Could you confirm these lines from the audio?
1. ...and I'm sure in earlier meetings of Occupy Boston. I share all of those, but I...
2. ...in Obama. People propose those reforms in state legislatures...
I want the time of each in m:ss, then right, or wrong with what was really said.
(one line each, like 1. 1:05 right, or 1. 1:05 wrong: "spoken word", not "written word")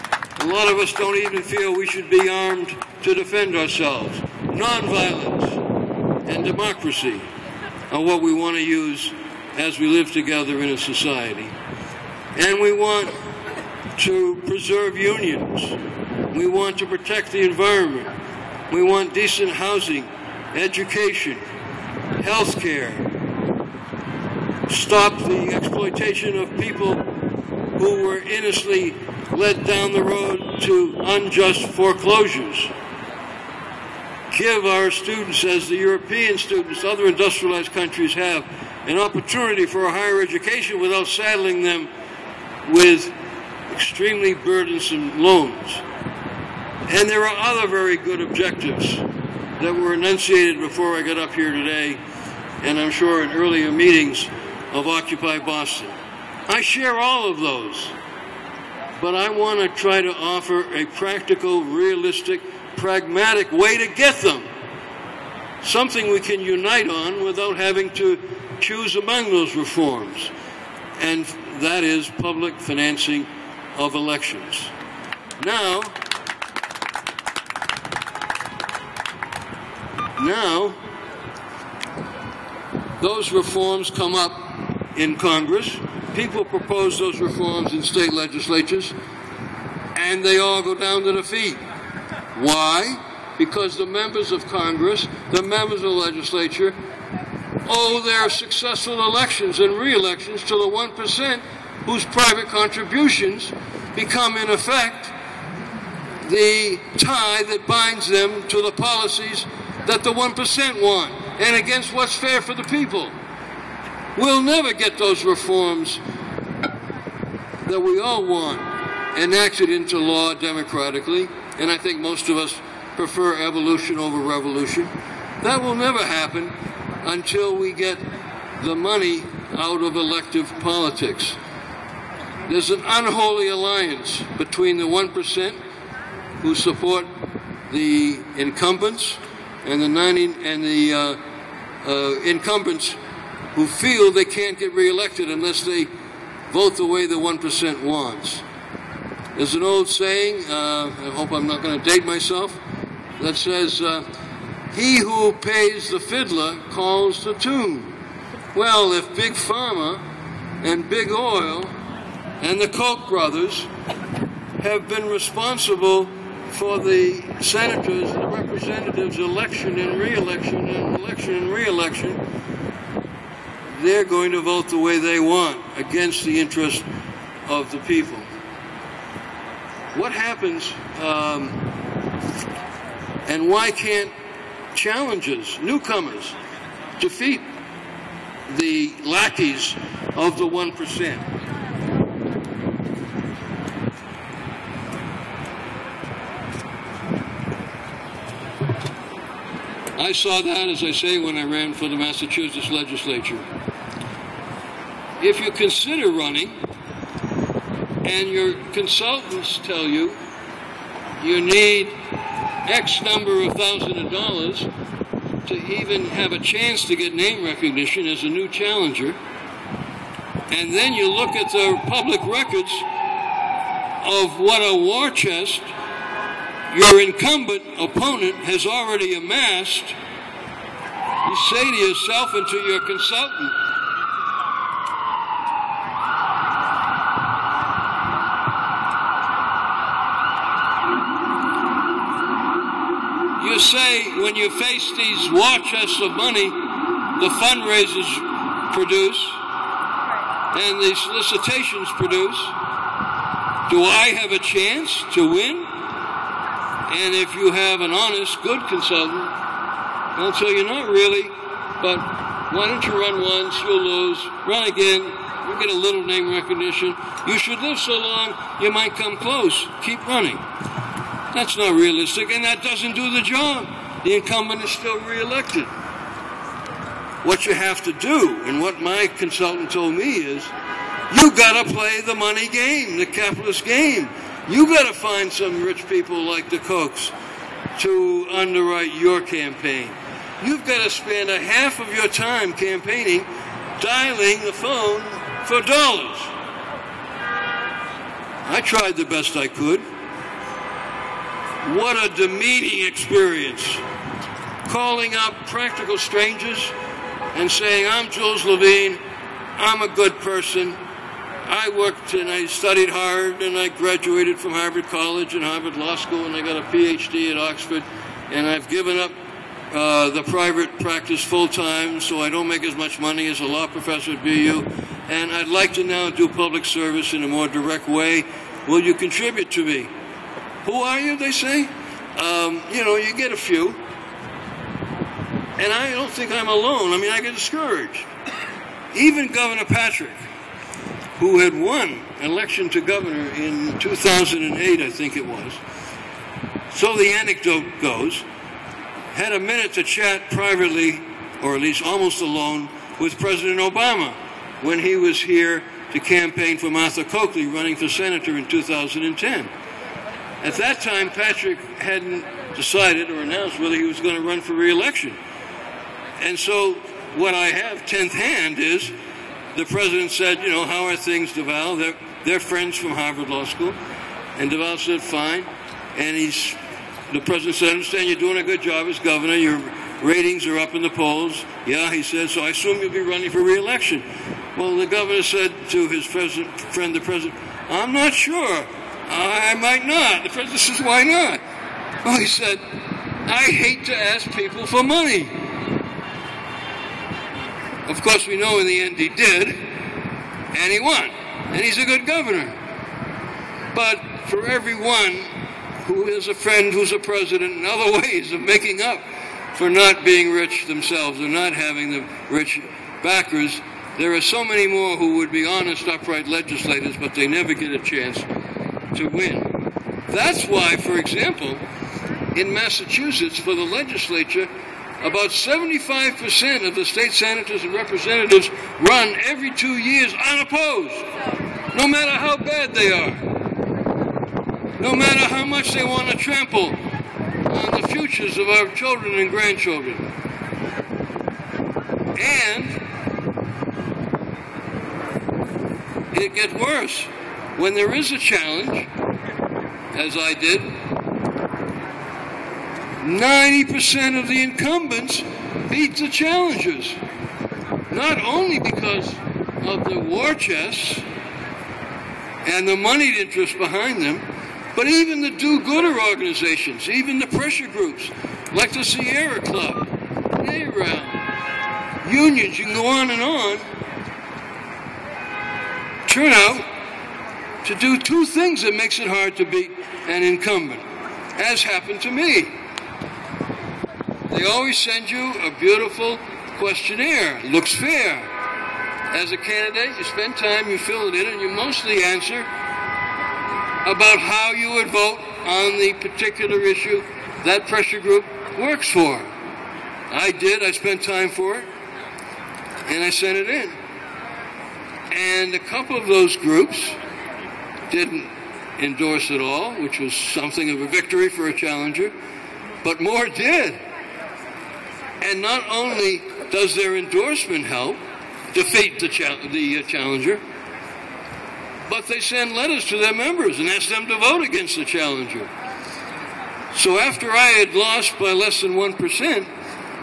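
1. 0:52 right
2. 1:25 wrong: "Congress", not "Obama".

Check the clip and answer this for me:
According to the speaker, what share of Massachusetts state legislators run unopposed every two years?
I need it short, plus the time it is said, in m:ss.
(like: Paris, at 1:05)
75%, at 7:05.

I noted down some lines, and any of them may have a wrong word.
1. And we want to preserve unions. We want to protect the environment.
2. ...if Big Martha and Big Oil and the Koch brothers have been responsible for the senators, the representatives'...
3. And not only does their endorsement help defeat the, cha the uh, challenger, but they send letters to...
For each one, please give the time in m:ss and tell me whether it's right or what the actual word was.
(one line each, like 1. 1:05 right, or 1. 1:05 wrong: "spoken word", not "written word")
1. 0:12 right
2. 2:38 wrong: "Pharma", not "Martha"
3. 8:35 right.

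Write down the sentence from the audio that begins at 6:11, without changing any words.
They're, they're friends from Harvard Law School.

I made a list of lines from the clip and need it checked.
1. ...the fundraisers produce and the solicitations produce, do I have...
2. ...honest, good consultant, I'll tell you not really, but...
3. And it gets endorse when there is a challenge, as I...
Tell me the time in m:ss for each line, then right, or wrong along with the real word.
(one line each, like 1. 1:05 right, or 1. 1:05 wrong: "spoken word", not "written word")
1. 4:07 right
2. 4:17 right
3. 7:22 wrong: "worse", not "endorse".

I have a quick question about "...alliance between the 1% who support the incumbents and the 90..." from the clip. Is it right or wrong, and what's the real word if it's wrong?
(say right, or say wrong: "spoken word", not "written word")
right.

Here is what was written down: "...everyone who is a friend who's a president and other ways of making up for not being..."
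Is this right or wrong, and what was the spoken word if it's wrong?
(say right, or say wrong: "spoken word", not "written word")
right.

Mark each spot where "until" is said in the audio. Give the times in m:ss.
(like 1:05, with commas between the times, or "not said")
2:07.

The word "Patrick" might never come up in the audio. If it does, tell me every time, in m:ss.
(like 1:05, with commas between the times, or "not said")
5:39, 6:01.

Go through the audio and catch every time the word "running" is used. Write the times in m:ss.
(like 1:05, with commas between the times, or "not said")
3:26, 4:30, 5:57, 6:23.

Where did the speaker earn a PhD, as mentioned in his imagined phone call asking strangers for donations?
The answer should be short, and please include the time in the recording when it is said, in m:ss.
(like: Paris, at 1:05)
Oxford, at 5:17.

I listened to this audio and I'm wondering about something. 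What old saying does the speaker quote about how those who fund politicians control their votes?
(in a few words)
He who pays the fiddler calls the tune.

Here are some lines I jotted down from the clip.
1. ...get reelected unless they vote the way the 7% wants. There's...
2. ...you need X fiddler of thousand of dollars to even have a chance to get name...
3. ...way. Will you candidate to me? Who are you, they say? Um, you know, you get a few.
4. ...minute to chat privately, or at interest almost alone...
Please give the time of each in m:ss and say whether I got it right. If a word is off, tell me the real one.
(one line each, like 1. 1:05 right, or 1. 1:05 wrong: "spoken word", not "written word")
1. 2:24 wrong: "1", not "7"
2. 3:31 wrong: "number", not "fiddler"
3. 5:27 wrong: "contribute", not "candidate"
4. 5:49 wrong: "least", not "interest".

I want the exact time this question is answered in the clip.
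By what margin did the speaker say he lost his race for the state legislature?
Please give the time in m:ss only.
8:48.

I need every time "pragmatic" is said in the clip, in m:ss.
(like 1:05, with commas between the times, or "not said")
1:02.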